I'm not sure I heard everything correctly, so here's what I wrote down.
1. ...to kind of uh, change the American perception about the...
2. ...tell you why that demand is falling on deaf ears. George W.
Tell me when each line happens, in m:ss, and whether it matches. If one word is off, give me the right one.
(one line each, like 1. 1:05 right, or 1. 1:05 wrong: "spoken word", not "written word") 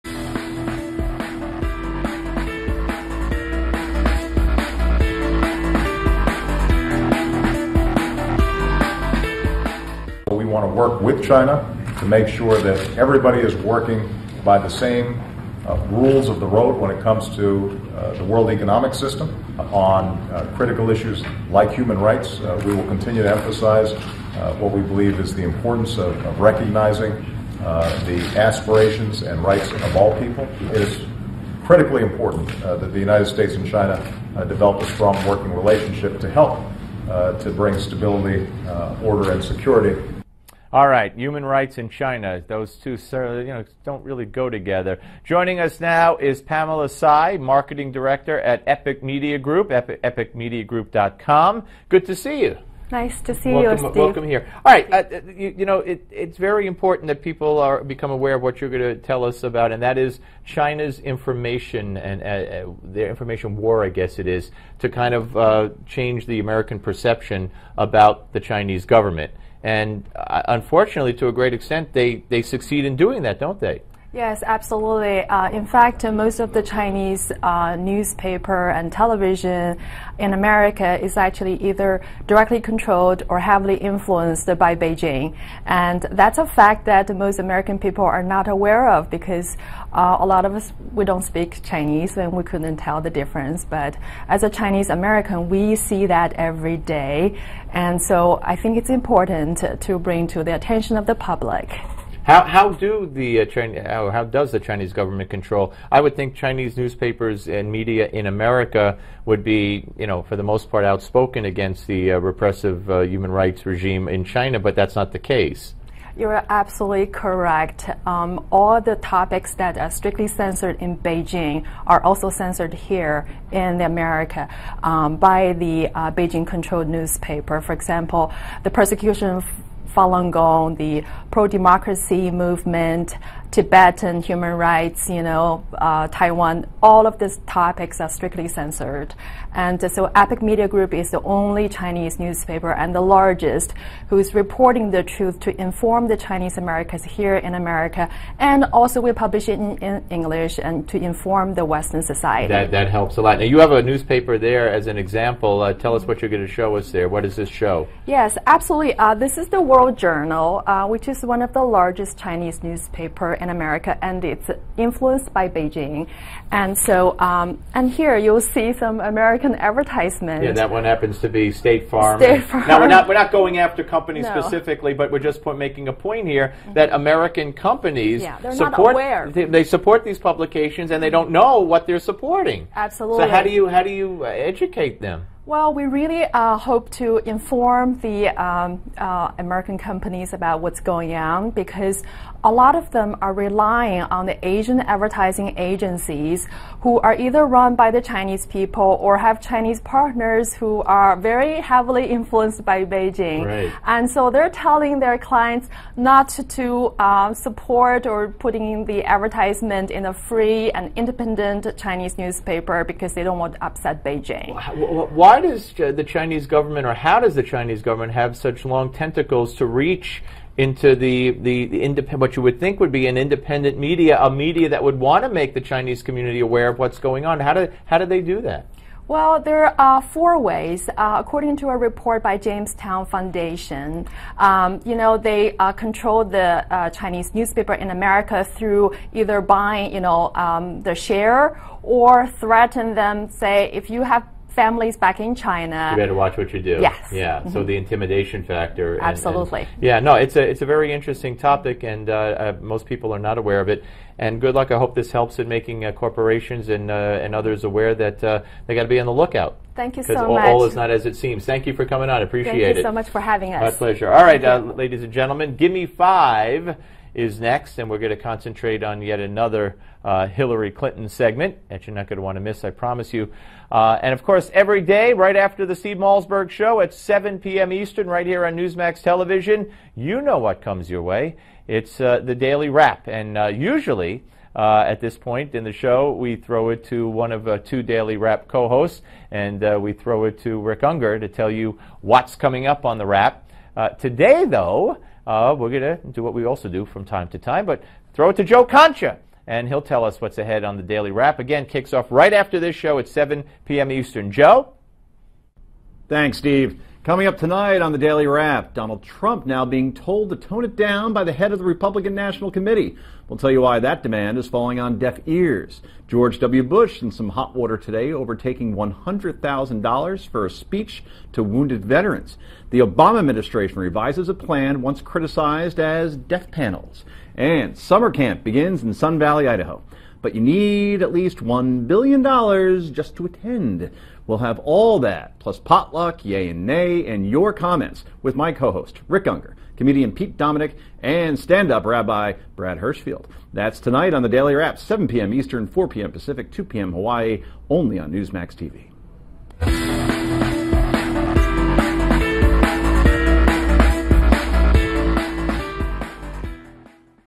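1. 1:04 right
2. 5:13 right.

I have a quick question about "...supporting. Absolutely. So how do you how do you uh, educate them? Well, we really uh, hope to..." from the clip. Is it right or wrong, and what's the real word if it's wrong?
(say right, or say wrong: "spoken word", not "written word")
right.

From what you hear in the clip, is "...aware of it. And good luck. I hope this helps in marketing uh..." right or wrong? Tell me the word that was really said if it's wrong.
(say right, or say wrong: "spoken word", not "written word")
wrong: "making", not "marketing".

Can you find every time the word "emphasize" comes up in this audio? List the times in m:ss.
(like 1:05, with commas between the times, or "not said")
0:23.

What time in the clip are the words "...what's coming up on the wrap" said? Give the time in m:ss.
4:52.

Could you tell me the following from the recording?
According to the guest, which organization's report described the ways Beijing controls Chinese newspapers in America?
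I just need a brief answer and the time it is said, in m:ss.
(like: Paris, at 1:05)
Jamestown Foundation, at 3:52.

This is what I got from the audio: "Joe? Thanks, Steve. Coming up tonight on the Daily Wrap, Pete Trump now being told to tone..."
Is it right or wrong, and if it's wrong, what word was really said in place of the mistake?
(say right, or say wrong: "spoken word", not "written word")
wrong: "Donald", not "Pete".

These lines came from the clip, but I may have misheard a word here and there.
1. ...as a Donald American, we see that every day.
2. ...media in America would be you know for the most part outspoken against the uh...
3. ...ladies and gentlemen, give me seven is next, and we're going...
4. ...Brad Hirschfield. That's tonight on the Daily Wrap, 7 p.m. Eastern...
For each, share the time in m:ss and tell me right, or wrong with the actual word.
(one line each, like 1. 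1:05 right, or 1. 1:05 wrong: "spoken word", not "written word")
1. 1:34 wrong: "Chinese", not "Donald"
2. 1:47 right
3. 4:24 wrong: "five", not "seven"
4. 5:42 right.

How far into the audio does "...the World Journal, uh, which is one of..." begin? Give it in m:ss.
2:39.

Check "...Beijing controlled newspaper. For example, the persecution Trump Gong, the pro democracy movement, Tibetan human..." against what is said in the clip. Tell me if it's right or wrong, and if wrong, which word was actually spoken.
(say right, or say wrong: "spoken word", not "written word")
wrong: "Falun", not "Trump".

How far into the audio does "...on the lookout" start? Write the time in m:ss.
4:19.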